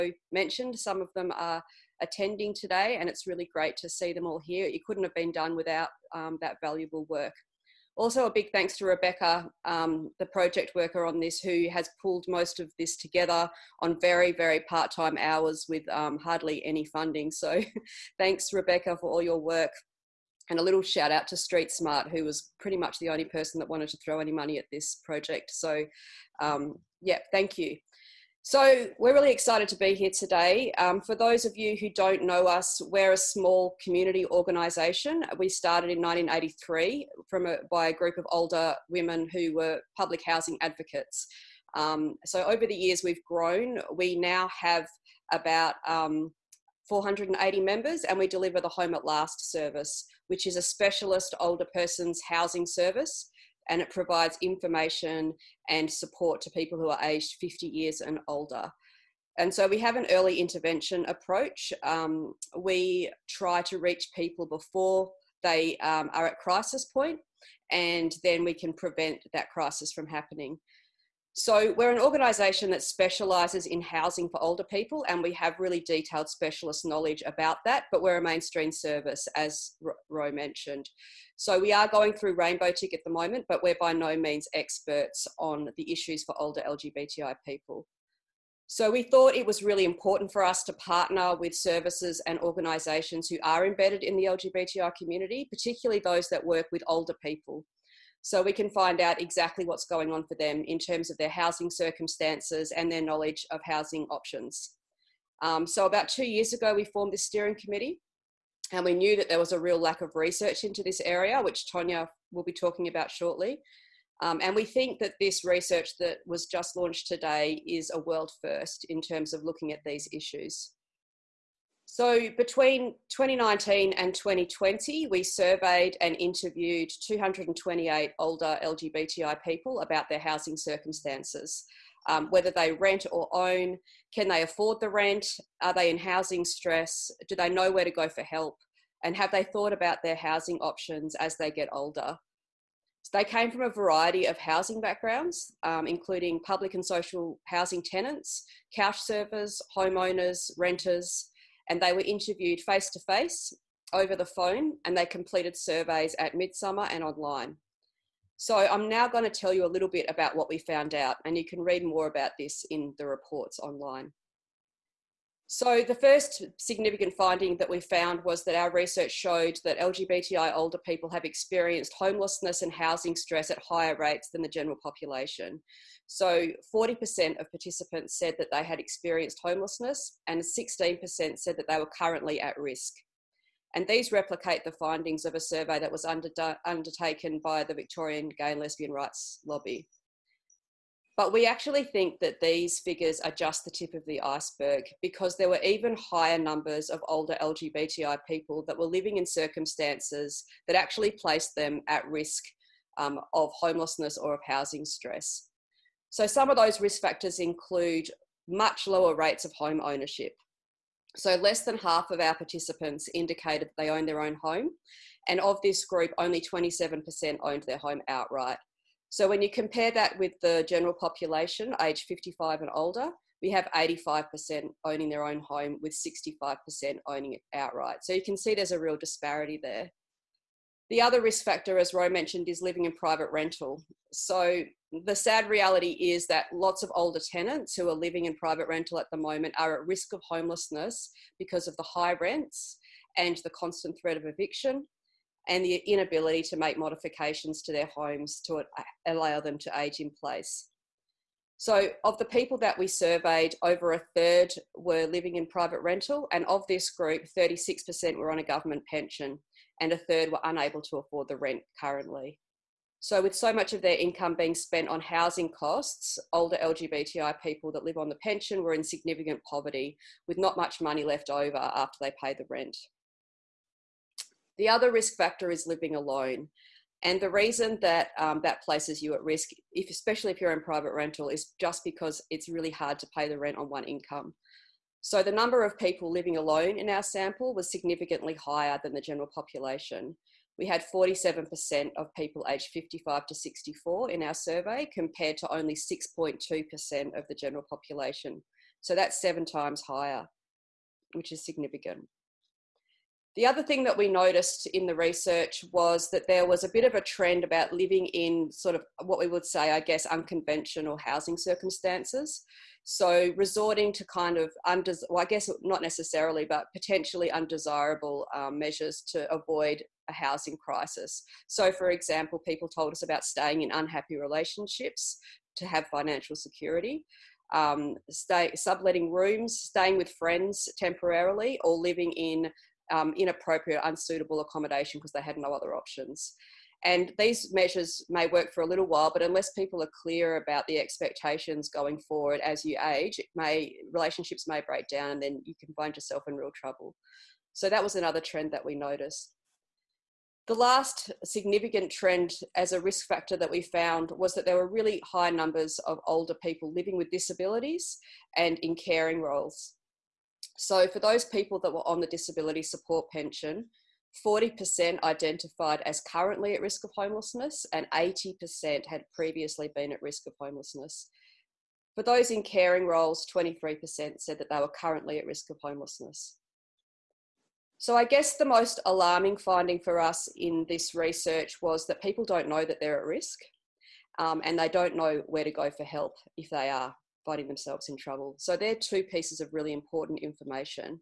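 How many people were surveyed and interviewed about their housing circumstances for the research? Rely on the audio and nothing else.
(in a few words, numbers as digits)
228.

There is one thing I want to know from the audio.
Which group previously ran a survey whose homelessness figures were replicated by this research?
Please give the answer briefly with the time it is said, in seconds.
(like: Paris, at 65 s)
Victorian Gay and Lesbian Rights Lobby, at 187 s.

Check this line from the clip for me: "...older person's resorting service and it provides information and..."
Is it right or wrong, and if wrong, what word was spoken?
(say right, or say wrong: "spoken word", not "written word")
wrong: "housing", not "resorting".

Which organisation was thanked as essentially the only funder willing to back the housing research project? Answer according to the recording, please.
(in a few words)
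Street Smart.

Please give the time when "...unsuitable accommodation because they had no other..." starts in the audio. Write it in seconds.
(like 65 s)
333 s.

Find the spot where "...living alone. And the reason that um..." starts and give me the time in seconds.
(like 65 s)
275 s.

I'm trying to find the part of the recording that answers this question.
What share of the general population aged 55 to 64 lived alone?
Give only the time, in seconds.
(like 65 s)
295 s.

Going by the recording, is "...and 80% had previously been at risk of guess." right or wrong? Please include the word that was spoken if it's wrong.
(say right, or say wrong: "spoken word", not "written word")
wrong: "homelessness", not "guess".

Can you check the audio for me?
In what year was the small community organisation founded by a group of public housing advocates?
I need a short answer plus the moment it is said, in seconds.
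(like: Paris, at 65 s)
1983, at 35 s.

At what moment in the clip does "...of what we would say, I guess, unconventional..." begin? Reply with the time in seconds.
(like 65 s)
308 s.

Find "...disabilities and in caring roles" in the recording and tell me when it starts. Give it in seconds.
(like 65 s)
357 s.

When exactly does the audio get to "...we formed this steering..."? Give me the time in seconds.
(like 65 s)
106 s.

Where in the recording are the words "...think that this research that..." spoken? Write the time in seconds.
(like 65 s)
114 s.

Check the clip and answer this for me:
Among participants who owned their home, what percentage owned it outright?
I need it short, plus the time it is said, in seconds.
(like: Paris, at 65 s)
27%, at 216 s.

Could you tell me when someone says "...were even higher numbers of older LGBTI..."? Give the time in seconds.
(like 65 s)
195 s.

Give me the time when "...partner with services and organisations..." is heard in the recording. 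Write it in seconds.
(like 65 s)
90 s.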